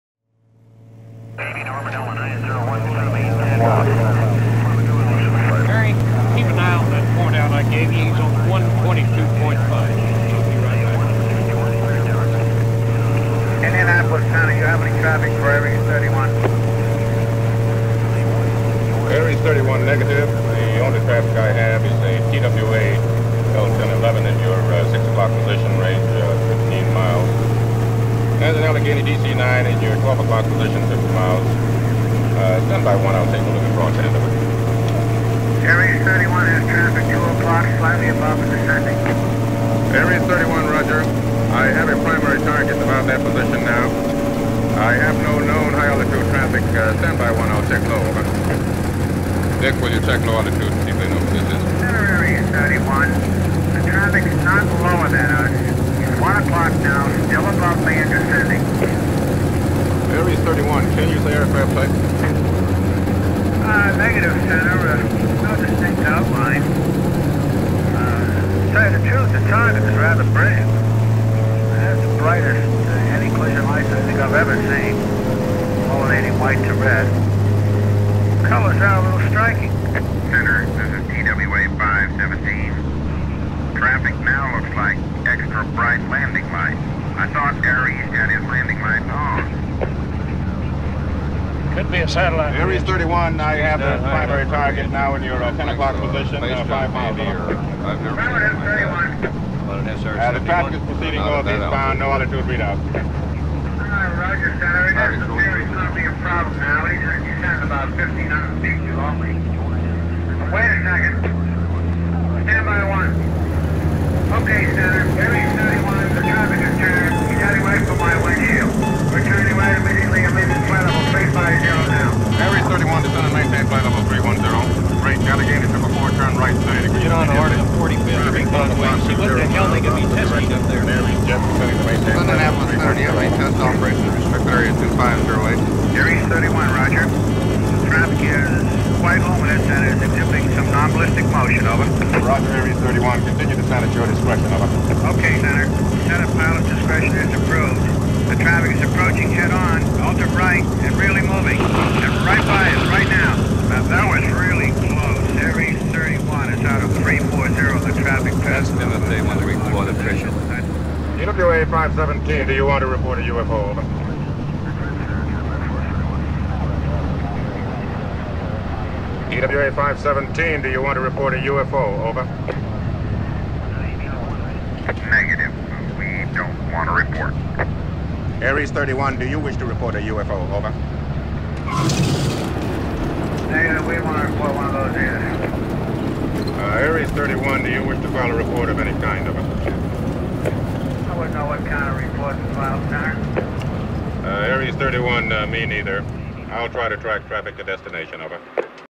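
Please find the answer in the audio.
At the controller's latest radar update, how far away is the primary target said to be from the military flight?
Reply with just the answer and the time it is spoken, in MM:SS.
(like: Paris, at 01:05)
5 miles, at 01:36.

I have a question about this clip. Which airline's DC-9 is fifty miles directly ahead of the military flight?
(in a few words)
Allegheny.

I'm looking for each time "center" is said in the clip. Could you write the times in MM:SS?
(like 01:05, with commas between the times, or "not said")
01:04, 01:20, 02:25.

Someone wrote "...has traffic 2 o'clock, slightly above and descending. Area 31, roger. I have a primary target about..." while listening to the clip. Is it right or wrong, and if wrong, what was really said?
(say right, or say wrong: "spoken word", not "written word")
right.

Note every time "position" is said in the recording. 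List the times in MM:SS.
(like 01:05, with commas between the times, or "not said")
00:25, 00:30, 00:43, 01:35.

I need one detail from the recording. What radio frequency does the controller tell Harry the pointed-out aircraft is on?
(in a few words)
122.5.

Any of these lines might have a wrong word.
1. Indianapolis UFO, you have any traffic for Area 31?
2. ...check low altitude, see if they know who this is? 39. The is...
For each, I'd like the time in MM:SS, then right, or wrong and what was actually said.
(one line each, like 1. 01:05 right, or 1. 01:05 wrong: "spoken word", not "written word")
1. 00:13 wrong: "County", not "UFO"
2. 00:50 wrong: "31", not "39".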